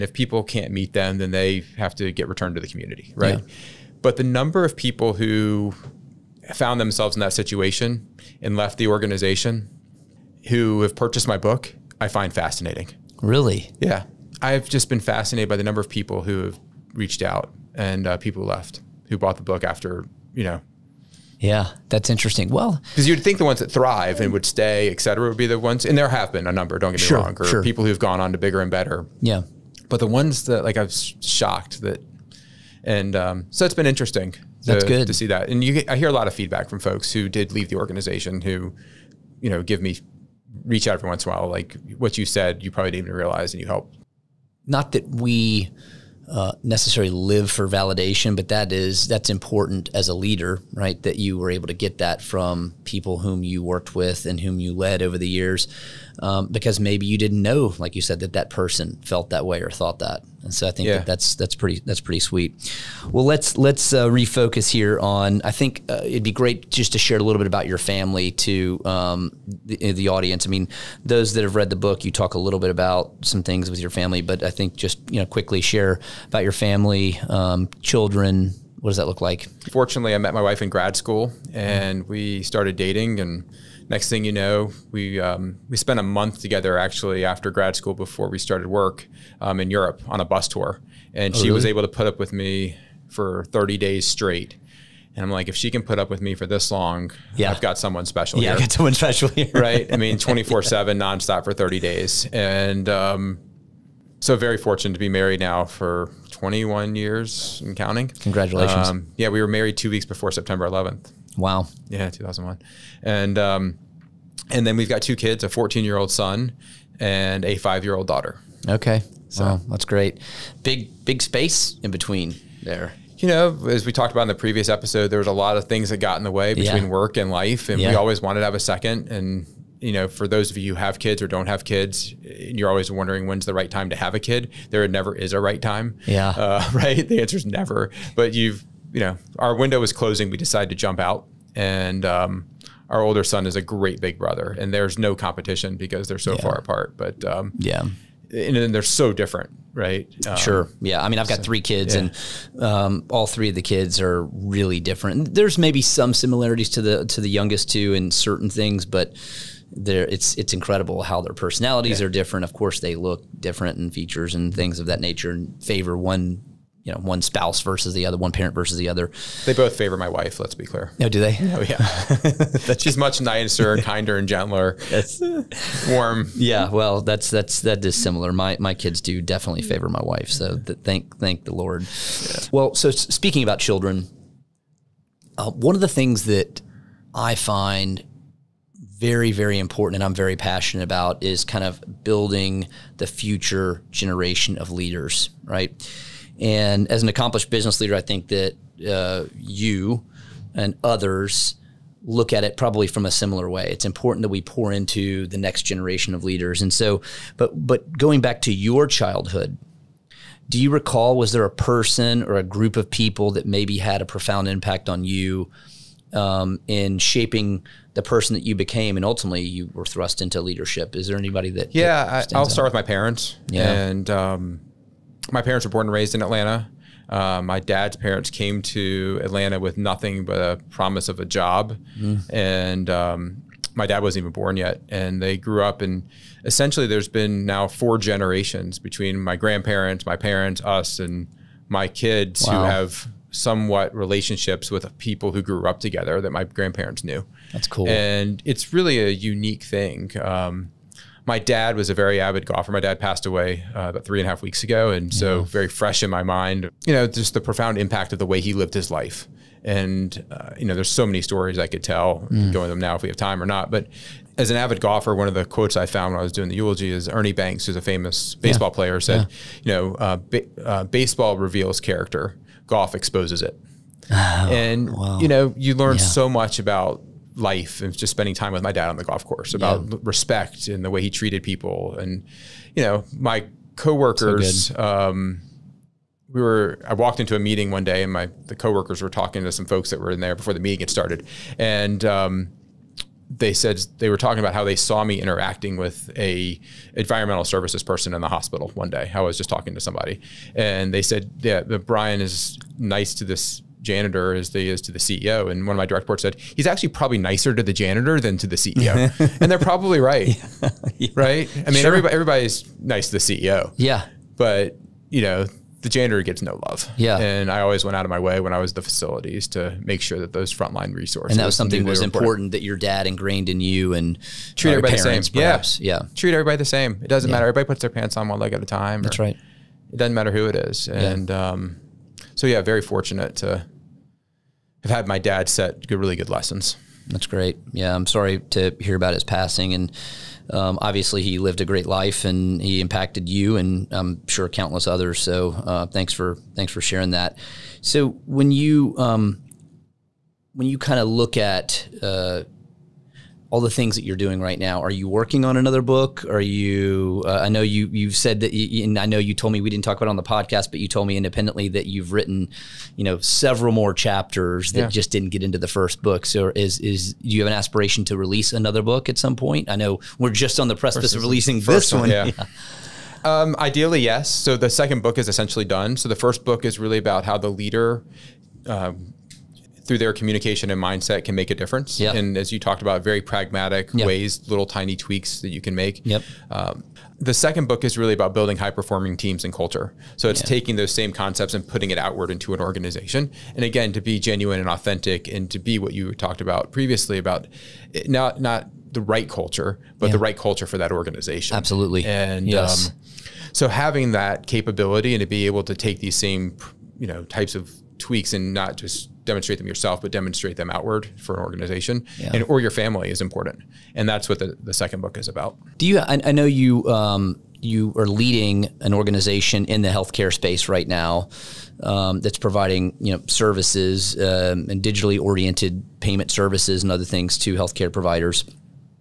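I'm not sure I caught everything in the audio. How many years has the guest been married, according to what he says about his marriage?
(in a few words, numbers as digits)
21.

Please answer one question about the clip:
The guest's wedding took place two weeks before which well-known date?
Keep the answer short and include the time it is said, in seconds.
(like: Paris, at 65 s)
September 11th, at 110 s.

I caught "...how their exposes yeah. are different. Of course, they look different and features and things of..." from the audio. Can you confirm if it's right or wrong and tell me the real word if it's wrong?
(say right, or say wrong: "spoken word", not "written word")
wrong: "personalities", not "exposes".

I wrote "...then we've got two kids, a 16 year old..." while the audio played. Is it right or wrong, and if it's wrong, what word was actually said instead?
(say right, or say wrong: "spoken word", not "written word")
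wrong: "14", not "16".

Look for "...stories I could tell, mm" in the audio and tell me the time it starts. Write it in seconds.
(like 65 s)
261 s.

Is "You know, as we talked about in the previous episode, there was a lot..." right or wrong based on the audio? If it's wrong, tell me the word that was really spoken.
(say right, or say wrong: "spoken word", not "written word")
right.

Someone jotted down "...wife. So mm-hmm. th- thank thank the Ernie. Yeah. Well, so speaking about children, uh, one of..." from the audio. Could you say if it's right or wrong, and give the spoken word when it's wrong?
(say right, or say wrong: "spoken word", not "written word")
wrong: "Lord", not "Ernie".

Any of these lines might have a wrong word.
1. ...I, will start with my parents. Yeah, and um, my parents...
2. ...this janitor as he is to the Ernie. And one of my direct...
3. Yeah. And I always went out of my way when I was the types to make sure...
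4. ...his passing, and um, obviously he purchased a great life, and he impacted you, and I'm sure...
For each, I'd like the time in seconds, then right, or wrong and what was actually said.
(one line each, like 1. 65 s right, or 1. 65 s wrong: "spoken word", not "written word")
1. 222 s right
2. 303 s wrong: "CEO", not "Ernie"
3. 316 s wrong: "facilities", not "types"
4. 339 s wrong: "lived", not "purchased".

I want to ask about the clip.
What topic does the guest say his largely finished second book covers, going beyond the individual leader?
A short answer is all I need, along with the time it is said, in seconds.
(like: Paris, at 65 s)
High performing teams and culture, at 388 s.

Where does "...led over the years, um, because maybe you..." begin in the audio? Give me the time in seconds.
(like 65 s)
54 s.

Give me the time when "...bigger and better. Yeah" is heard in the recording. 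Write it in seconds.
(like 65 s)
28 s.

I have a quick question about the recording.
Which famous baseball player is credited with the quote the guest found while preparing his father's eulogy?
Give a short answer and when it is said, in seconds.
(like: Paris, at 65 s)
Ernie Banks, at 267 s.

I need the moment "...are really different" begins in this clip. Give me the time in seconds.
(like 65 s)
154 s.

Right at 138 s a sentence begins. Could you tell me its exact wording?
But you've you know, our window was closing.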